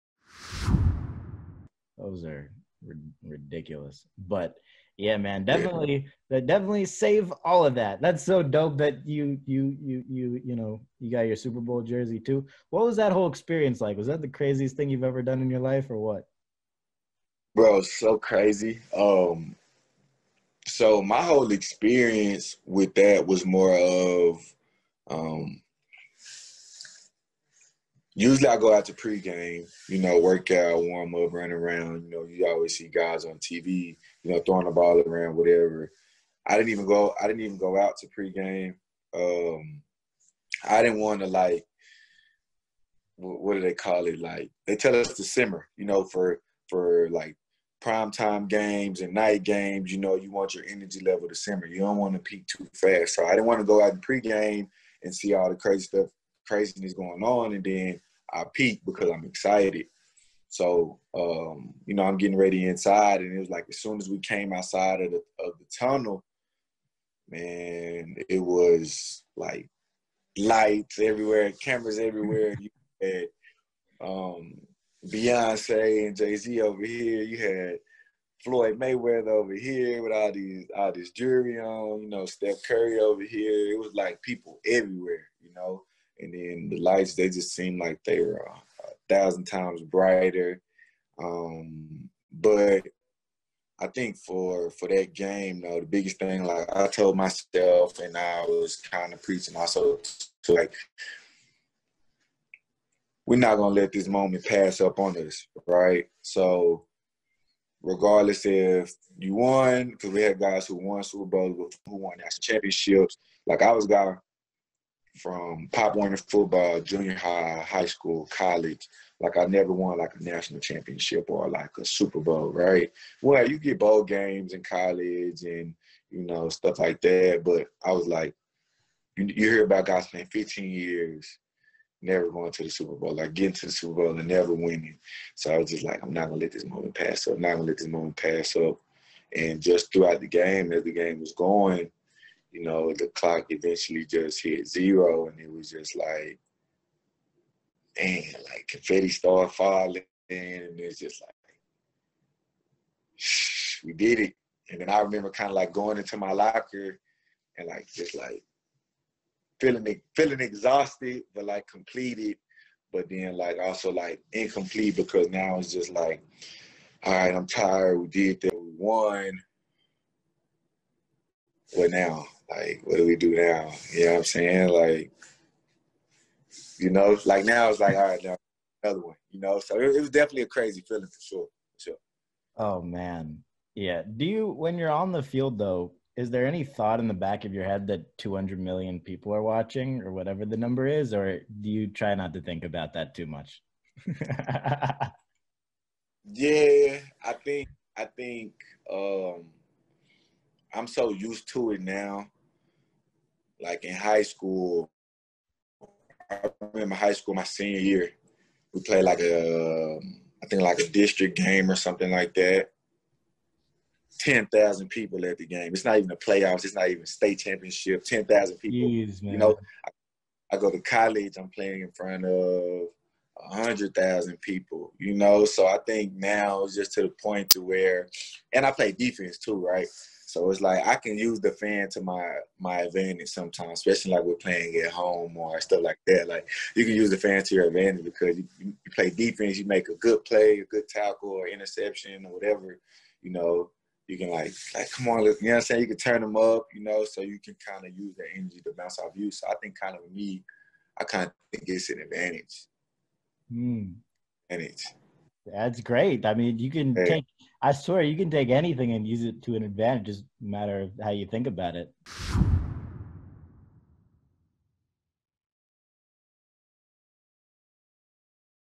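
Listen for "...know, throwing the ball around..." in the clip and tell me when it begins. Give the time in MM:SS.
00:34.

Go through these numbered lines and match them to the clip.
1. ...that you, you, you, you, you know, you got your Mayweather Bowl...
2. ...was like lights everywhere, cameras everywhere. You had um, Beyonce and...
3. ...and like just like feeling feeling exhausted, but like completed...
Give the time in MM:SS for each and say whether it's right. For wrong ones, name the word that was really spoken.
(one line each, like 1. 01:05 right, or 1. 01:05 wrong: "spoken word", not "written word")
1. 00:08 wrong: "Super", not "Mayweather"
2. 01:08 right
3. 02:37 right.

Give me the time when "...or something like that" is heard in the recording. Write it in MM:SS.
03:31.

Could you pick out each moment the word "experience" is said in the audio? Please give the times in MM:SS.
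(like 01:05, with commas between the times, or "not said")
00:13, 00:21.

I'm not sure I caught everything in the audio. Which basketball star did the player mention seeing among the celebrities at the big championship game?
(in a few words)
Steph Curry.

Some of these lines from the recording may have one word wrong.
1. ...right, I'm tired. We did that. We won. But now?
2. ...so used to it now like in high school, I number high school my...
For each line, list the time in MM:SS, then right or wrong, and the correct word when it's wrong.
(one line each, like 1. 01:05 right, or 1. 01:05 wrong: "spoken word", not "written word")
1. 02:47 right
2. 03:20 wrong: "remember", not "number".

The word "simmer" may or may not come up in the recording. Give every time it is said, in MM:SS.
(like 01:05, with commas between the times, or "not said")
00:45, 00:51.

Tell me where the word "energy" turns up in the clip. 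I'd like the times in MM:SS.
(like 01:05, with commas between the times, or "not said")
00:50, 04:08.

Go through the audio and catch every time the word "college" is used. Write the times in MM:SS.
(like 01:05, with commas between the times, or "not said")
01:58, 02:04, 03:40.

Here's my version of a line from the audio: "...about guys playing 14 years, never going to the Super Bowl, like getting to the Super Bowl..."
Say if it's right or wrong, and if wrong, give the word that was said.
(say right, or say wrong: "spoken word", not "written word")
wrong: "15", not "14".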